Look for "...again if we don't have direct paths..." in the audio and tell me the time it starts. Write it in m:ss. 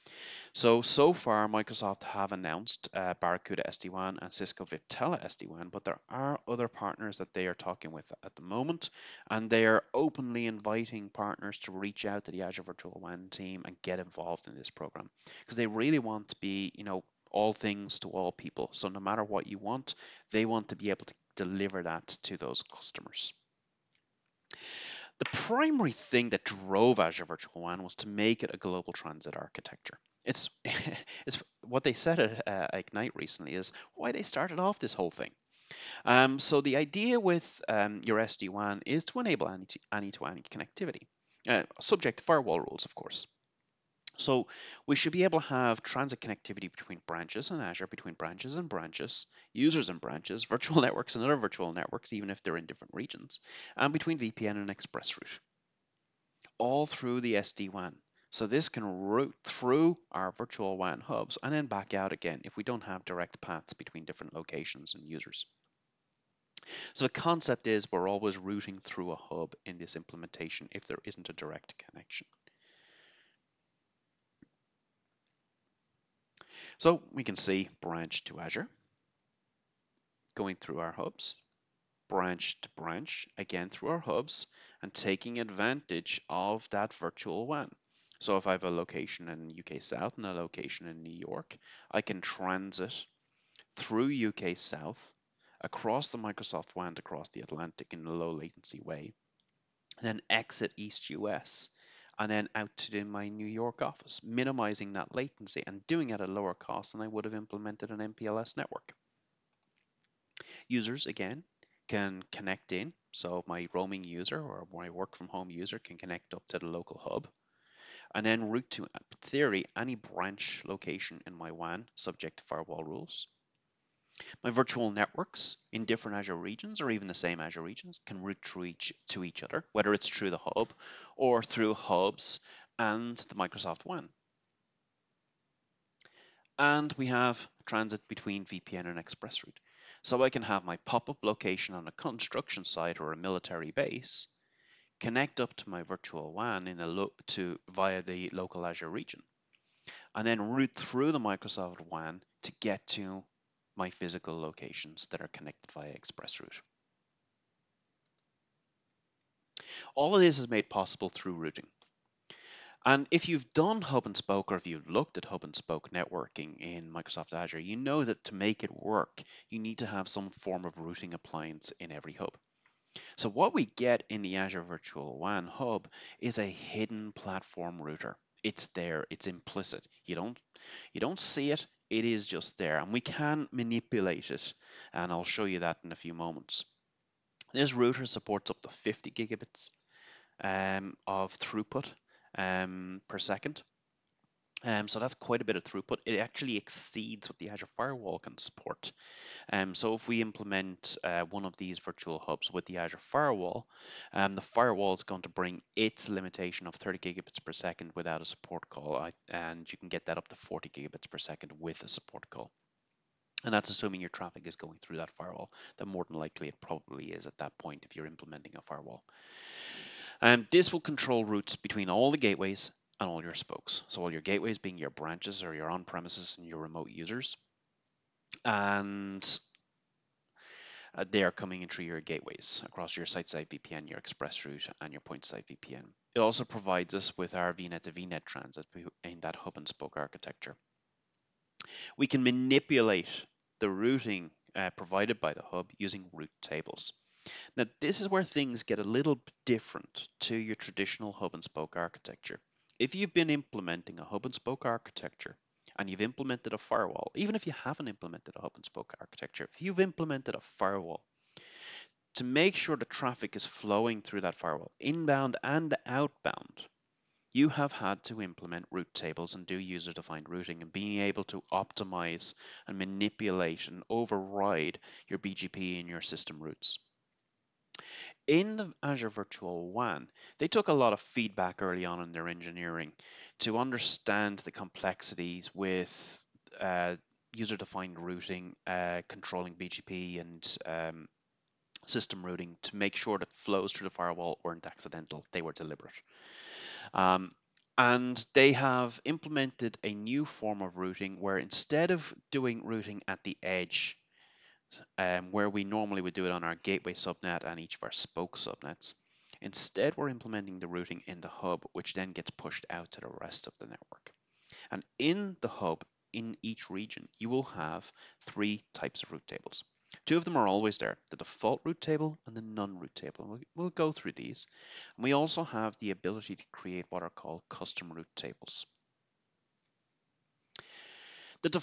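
1:02.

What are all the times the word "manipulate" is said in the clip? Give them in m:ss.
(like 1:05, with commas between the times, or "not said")
3:03, 4:02, 4:32.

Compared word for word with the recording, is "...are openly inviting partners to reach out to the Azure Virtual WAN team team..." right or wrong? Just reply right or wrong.
right.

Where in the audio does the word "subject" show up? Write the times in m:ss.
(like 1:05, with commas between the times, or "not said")
0:41, 2:01.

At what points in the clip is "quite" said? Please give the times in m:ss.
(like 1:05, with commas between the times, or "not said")
3:15.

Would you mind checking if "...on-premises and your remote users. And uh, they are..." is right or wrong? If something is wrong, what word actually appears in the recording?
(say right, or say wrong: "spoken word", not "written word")
right.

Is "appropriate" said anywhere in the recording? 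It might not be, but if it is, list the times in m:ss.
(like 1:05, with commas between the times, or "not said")
not said.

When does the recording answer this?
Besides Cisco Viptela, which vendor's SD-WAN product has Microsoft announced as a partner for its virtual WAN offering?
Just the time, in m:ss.
0:03.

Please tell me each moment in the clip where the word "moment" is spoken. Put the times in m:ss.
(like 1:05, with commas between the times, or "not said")
0:08, 3:06.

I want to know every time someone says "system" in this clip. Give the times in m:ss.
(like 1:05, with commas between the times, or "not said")
4:36, 4:51.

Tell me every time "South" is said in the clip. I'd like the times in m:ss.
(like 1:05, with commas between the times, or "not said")
1:29, 1:34.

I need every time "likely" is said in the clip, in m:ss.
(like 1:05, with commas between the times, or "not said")
3:36.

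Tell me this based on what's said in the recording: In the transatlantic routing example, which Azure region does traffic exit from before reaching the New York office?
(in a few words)
East US.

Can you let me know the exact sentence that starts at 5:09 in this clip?
Instead, we're implementing the routing in the hub, which then gets pushed out to the rest of the network.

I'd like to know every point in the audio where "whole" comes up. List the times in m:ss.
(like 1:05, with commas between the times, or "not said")
0:34.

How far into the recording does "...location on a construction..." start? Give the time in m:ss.
2:21.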